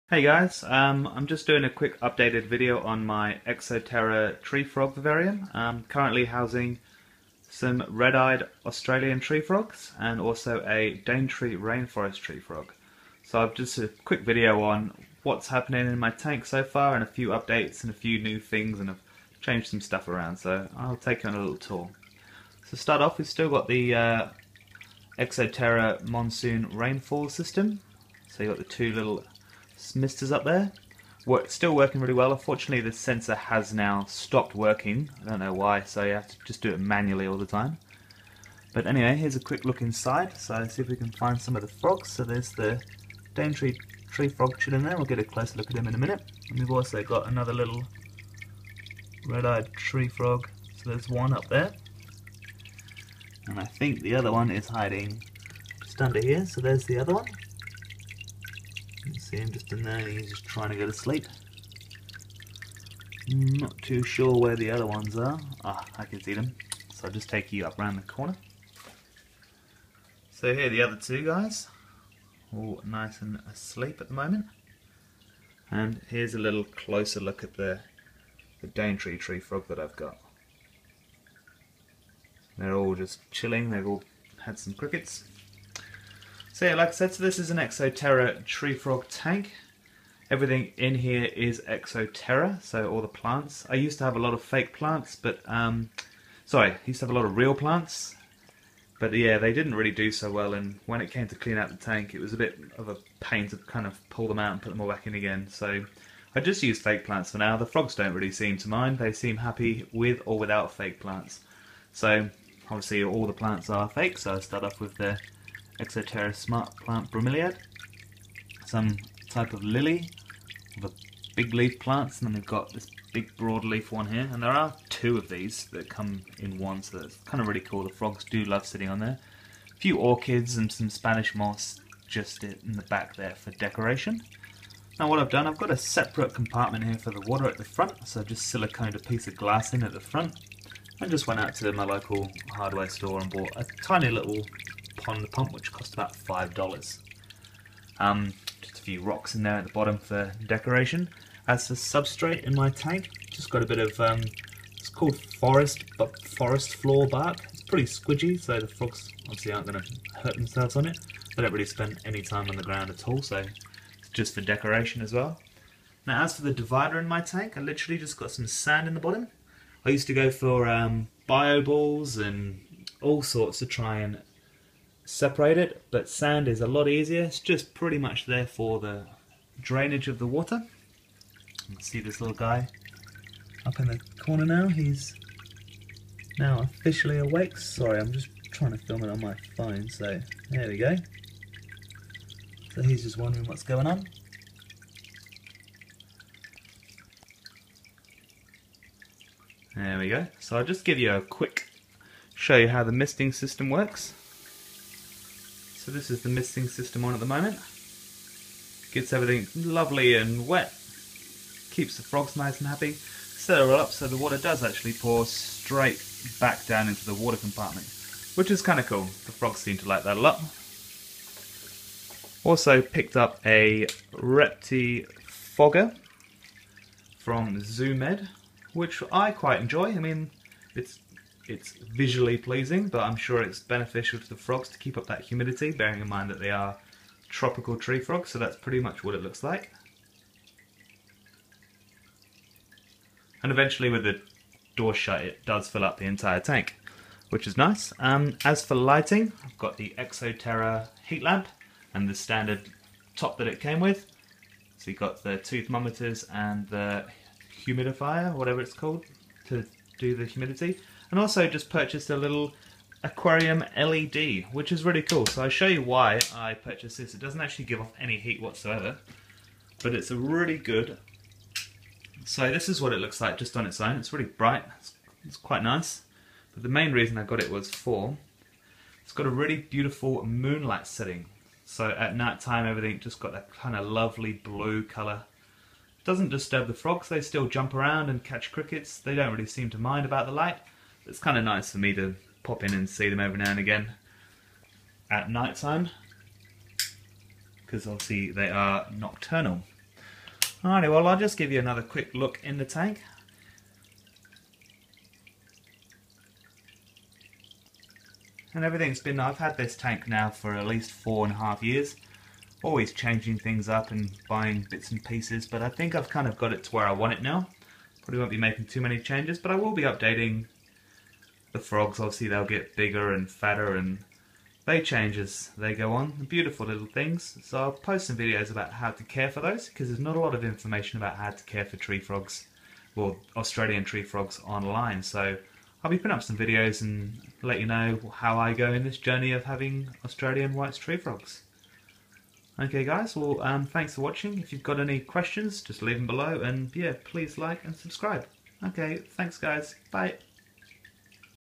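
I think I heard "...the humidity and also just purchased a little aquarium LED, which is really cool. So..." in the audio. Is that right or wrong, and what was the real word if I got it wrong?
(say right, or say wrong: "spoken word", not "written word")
right.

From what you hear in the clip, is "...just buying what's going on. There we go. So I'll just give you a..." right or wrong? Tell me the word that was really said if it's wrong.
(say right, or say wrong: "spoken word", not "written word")
wrong: "wondering", not "buying".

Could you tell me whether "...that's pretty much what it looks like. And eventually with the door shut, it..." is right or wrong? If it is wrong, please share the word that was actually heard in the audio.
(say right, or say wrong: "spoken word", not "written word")
right.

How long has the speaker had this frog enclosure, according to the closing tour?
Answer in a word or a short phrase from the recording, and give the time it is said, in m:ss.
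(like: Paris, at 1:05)
4 and a half years, at 5:10.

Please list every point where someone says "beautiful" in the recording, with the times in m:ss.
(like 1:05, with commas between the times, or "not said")
4:39, 5:26.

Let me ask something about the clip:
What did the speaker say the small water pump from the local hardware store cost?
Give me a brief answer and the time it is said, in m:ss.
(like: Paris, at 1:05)
$5, at 2:26.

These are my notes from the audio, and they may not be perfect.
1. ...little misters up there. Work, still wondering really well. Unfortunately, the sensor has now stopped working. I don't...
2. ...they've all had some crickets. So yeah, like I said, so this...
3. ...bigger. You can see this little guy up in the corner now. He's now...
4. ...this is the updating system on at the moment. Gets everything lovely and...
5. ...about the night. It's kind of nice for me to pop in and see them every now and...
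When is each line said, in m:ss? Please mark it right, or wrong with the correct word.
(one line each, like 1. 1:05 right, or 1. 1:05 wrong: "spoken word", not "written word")
1. 0:28 wrong: "working", not "wondering"
2. 1:23 right
3. 3:00 wrong: "water", not "bigger"
4. 3:25 wrong: "misting", not "updating"
5. 4:50 wrong: "light", not "night".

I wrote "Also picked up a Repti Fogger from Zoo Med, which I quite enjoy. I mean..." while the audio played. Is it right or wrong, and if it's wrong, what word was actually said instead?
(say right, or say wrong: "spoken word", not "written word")
right.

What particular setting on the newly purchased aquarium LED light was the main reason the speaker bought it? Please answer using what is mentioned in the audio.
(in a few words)
moonlight setting.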